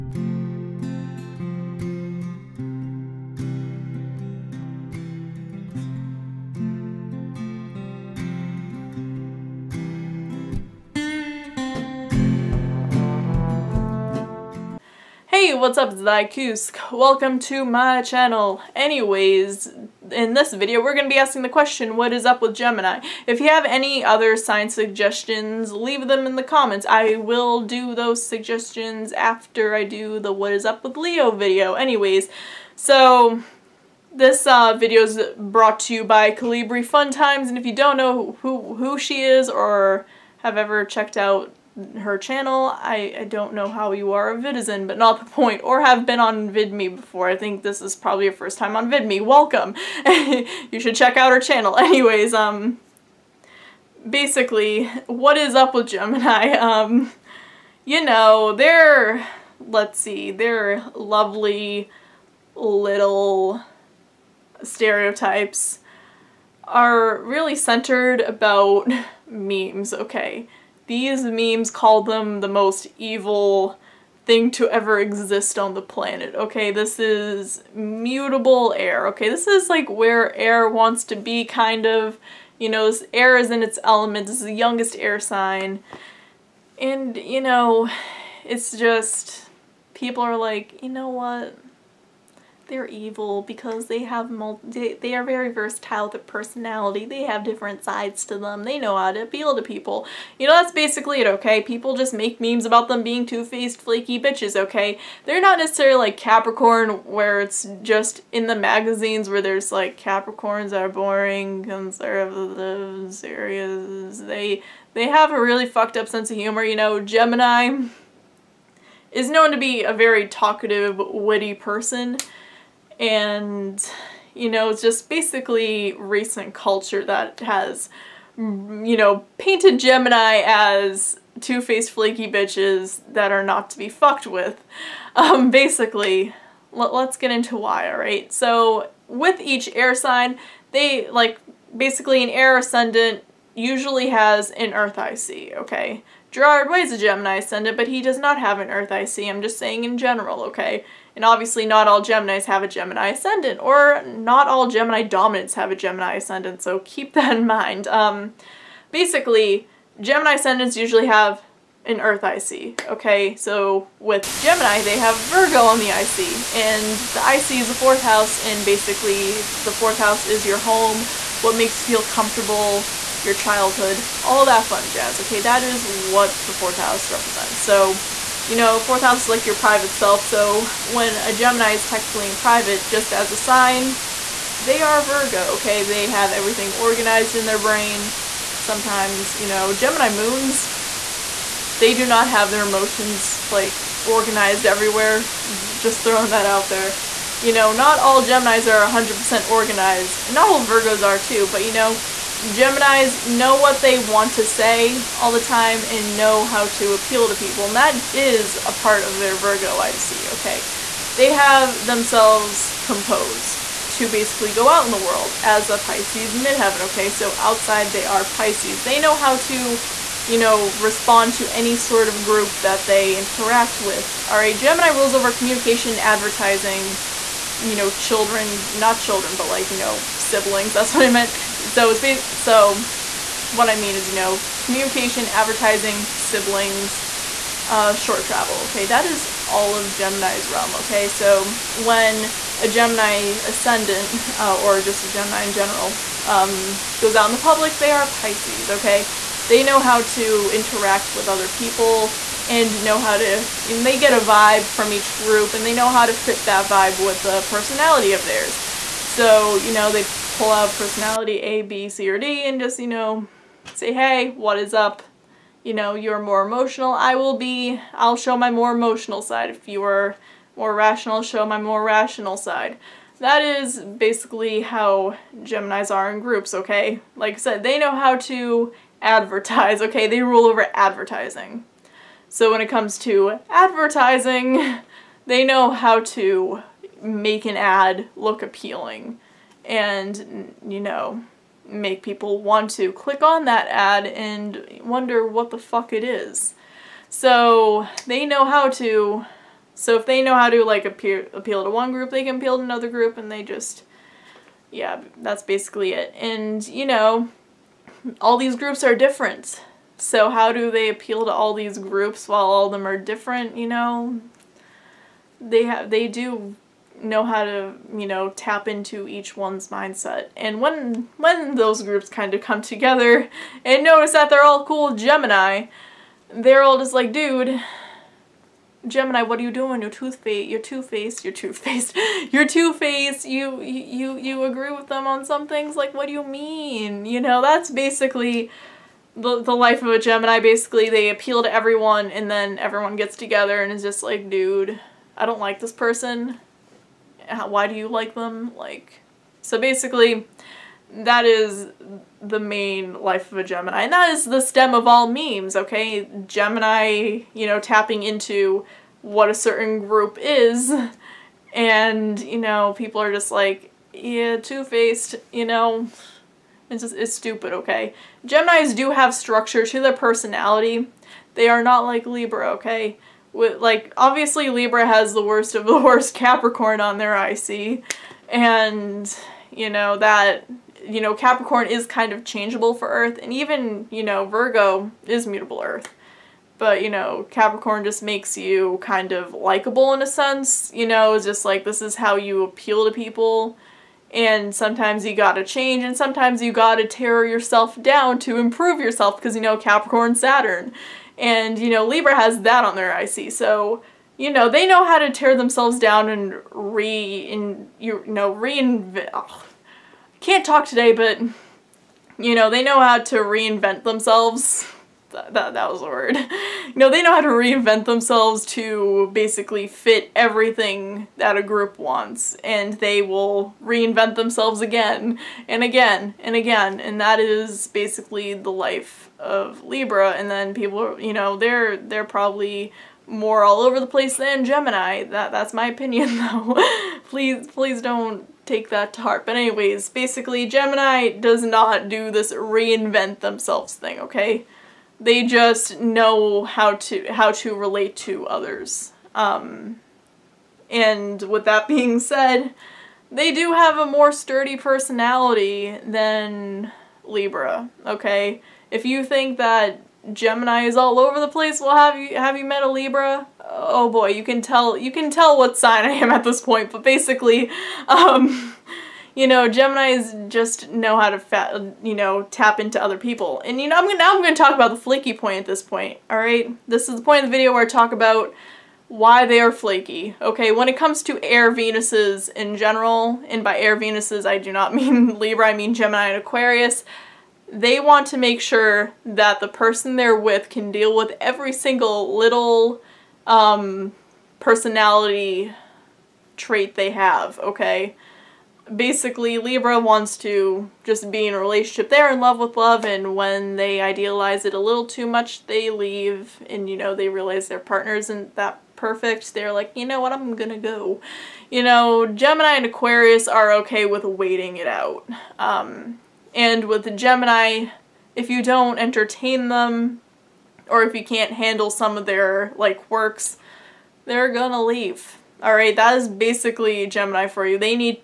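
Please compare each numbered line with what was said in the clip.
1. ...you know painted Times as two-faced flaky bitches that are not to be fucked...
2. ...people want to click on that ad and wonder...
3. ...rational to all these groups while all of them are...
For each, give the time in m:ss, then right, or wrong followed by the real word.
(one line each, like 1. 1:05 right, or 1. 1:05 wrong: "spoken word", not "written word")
1. 2:08 wrong: "Gemini", not "Times"
2. 4:52 right
3. 5:10 wrong: "appeal", not "rational".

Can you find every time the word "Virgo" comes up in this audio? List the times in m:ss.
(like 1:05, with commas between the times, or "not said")
2:45, 3:05, 3:20, 3:29, 6:24.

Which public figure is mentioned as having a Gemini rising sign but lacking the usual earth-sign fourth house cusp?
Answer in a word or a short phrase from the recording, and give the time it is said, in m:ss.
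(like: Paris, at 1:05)
Gerard Way, at 2:26.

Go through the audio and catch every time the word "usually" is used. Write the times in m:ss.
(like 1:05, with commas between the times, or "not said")
2:23, 2:40.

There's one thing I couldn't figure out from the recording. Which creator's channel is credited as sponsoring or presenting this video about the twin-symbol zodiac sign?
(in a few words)
Calibri Fun Times.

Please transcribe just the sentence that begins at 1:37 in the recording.
They have different sides to them.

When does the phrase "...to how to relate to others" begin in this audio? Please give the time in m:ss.
7:26.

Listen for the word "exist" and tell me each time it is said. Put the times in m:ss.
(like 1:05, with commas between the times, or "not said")
1:14.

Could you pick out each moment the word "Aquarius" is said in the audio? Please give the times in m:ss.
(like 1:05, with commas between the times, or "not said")
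8:06, 8:32.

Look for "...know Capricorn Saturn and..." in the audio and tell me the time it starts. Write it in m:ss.
6:39.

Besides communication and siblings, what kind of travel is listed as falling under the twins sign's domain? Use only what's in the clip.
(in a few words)
short travel.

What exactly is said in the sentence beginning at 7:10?
And then people, you know, they're they're probably more all over the place than Gemini.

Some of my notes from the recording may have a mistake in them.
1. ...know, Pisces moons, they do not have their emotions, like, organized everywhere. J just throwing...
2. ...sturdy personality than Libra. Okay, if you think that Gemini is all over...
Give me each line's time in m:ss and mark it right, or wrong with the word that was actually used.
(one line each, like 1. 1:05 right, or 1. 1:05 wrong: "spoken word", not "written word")
1. 3:09 wrong: "Gemini", not "Pisces"
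2. 7:34 right.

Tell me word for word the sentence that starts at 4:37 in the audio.
Like I said, they know how to advertise, okay?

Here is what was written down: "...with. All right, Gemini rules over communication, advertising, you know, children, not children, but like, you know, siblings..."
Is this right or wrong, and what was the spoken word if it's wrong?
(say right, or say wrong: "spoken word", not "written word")
right.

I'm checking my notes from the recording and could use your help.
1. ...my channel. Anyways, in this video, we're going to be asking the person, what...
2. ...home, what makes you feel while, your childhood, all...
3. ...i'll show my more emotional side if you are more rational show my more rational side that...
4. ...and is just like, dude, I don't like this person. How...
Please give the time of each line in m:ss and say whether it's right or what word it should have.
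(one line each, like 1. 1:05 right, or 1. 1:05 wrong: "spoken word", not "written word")
1. 0:17 wrong: "question", not "person"
2. 2:50 wrong: "comfortable", not "while"
3. 4:27 right
4. 5:43 right.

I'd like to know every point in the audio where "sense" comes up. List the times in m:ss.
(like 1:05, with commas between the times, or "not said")
1:56, 6:30.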